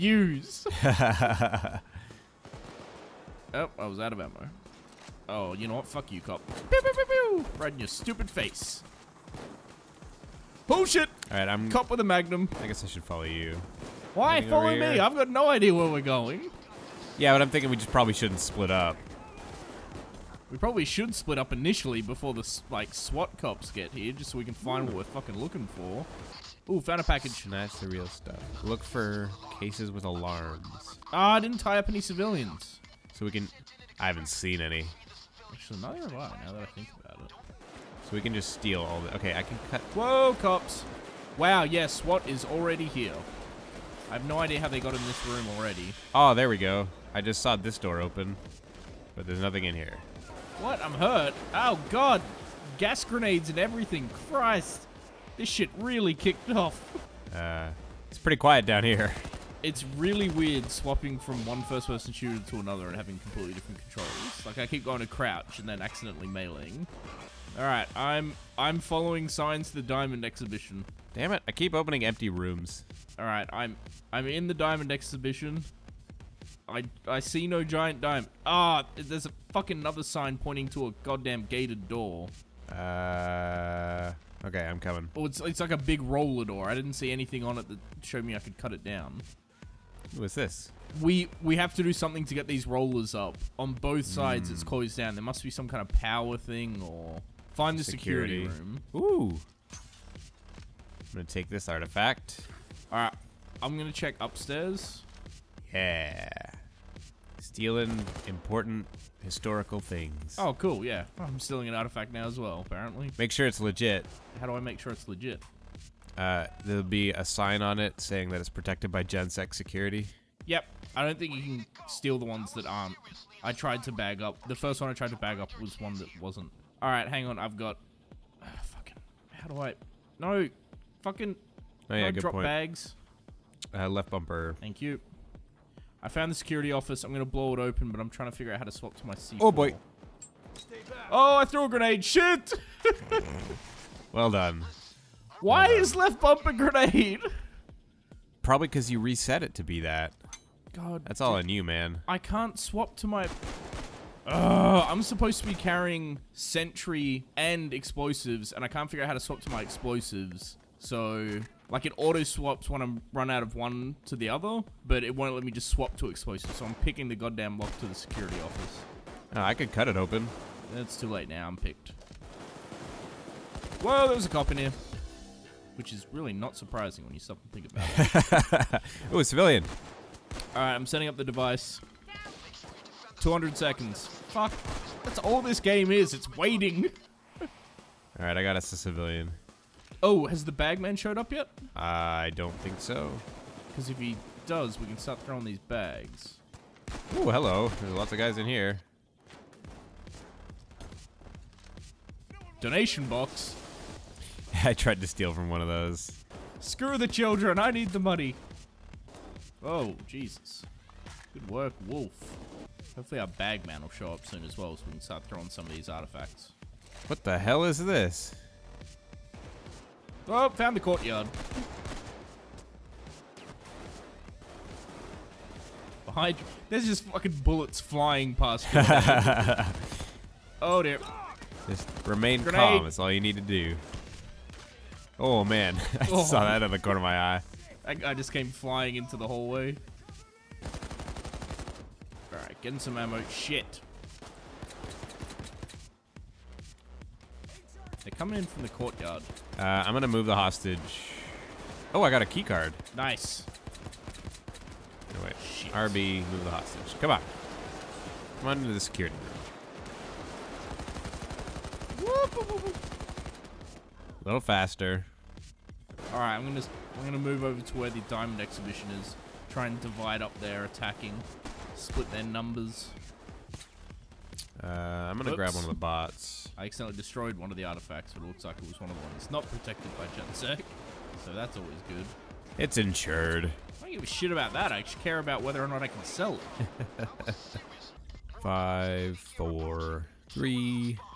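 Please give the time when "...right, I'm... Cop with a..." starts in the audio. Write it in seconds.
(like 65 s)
11 s.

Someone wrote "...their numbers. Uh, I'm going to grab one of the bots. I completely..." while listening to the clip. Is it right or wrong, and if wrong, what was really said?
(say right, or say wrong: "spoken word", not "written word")
wrong: "accidentally", not "completely".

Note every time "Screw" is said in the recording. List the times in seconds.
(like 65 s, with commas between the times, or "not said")
206 s.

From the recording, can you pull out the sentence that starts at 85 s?
Oh, it's it's like a big roller door.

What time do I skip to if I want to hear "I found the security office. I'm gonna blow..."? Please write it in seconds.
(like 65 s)
136 s.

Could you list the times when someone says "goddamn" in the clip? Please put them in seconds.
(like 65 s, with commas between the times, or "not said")
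81 s, 167 s.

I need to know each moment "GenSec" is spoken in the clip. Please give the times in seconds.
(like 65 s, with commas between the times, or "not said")
119 s, 280 s.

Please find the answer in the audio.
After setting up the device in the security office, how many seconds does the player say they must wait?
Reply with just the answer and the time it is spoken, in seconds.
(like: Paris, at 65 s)
200, at 183 s.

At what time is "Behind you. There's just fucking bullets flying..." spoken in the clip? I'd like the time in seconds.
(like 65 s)
226 s.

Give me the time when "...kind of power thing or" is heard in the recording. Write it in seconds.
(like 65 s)
95 s.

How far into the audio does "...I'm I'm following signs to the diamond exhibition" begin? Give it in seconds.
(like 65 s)
67 s.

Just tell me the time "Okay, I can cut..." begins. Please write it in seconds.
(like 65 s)
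39 s.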